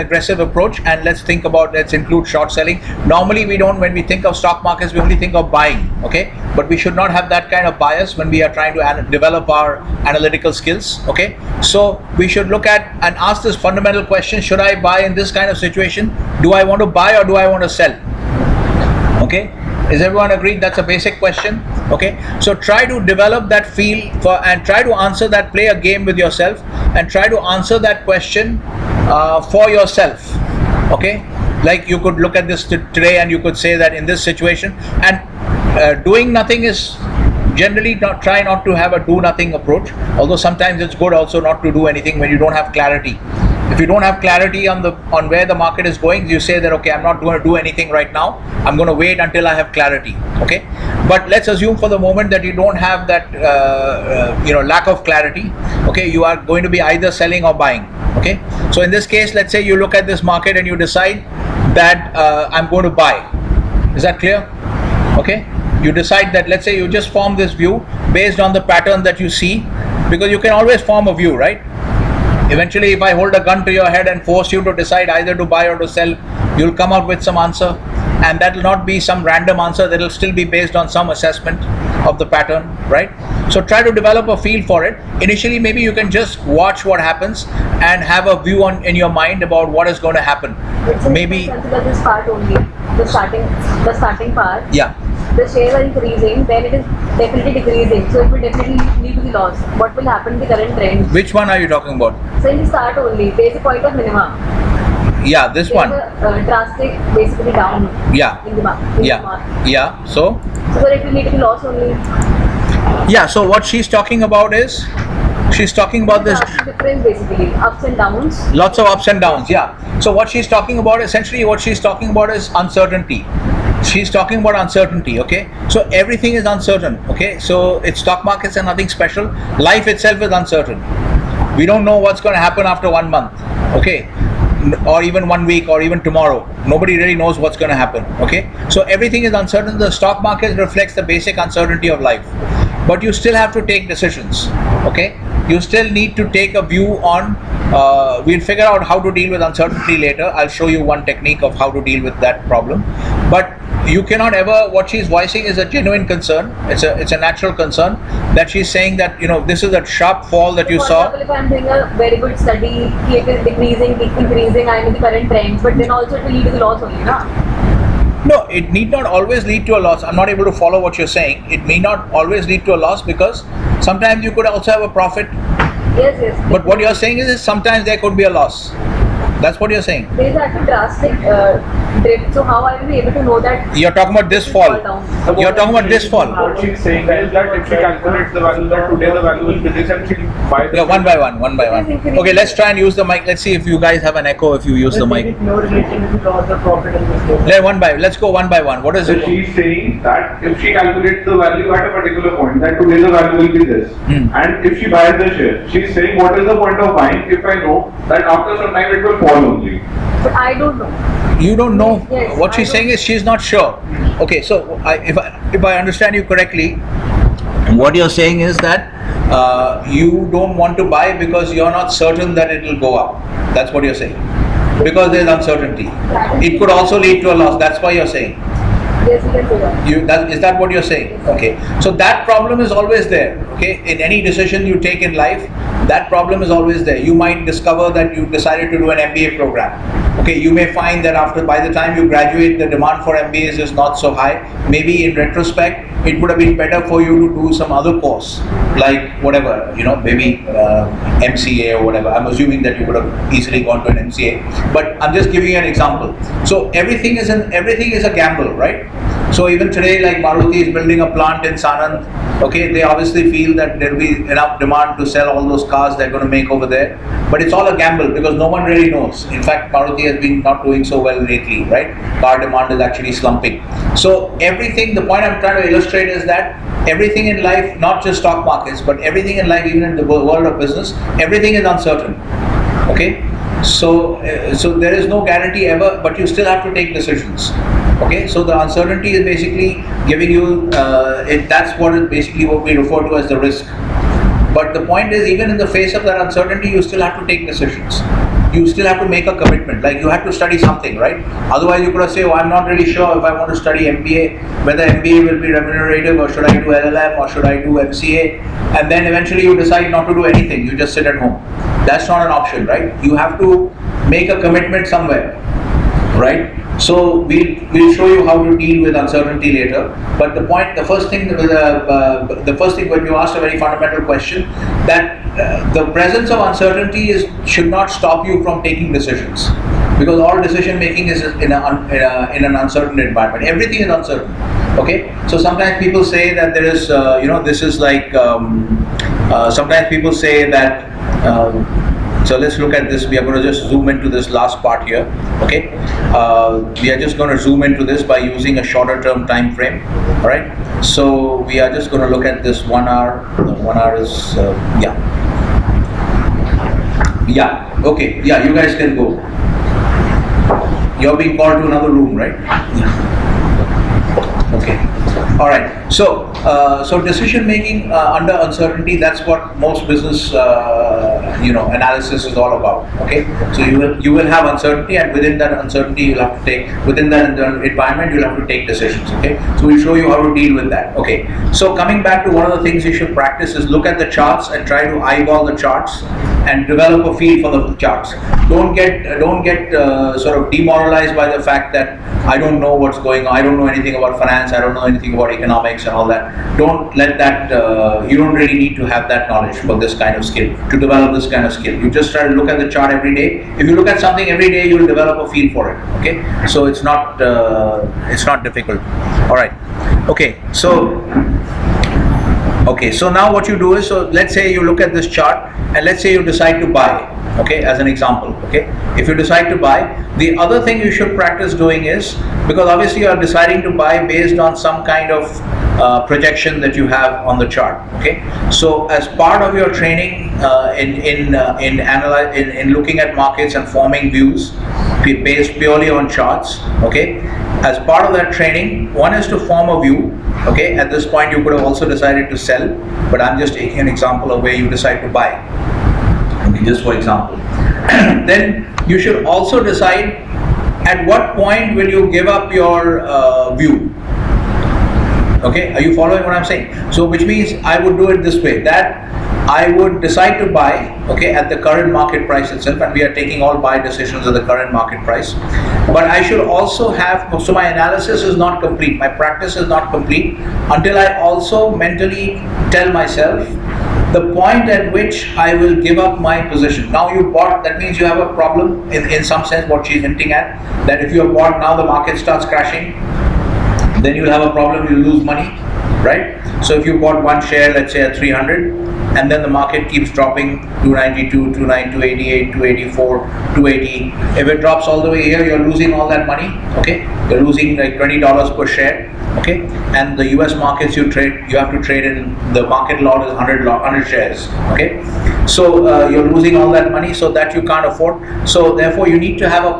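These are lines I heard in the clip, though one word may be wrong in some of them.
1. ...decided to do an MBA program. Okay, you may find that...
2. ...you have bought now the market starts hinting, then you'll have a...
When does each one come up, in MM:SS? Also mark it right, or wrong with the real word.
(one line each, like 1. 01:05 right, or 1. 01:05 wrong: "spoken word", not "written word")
1. 03:58 right
2. 08:01 wrong: "crashing", not "hinting".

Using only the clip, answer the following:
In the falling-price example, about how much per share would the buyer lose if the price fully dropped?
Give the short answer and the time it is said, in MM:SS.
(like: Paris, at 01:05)
$20, at 08:17.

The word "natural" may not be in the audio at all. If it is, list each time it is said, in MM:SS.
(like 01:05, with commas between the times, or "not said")
02:37.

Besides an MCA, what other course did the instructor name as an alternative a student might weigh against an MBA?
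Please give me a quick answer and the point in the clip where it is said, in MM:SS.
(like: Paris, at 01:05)
LLM, at 05:06.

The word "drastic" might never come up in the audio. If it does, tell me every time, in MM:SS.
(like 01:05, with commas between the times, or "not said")
01:46, 03:00.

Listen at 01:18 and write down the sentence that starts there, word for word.
And that'll not be some random answer, that'll still be based on some assessment of the pattern, right?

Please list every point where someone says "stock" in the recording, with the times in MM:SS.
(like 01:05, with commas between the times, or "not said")
00:04, 02:07, 02:19, 04:38.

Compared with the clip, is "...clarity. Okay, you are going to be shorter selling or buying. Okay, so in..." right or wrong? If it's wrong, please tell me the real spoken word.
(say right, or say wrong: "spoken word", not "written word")
wrong: "either", not "shorter".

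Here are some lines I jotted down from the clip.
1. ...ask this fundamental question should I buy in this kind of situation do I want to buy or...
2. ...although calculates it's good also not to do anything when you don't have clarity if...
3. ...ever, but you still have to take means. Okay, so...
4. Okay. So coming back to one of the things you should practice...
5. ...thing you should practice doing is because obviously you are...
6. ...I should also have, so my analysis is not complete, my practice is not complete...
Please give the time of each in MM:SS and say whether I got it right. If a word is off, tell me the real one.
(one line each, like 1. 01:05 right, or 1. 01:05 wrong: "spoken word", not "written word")
1. 00:13 right
2. 00:40 wrong: "sometimes", not "calculates"
3. 04:45 wrong: "decisions", not "means"
4. 06:20 right
5. 07:00 right
6. 07:46 right.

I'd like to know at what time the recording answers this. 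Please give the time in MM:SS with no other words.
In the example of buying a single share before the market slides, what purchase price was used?
08:08.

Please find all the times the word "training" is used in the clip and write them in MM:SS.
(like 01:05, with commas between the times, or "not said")
07:09, 07:18.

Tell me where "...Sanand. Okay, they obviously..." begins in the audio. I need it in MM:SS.
04:21.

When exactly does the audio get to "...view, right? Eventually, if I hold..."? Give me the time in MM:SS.
01:11.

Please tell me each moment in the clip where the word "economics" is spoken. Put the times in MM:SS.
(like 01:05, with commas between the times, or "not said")
06:35.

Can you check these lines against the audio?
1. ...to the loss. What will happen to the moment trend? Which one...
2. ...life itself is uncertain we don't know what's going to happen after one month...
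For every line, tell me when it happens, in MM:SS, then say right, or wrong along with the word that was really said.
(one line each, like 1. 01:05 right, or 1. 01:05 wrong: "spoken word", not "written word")
1. 01:39 wrong: "current", not "moment"
2. 02:09 right.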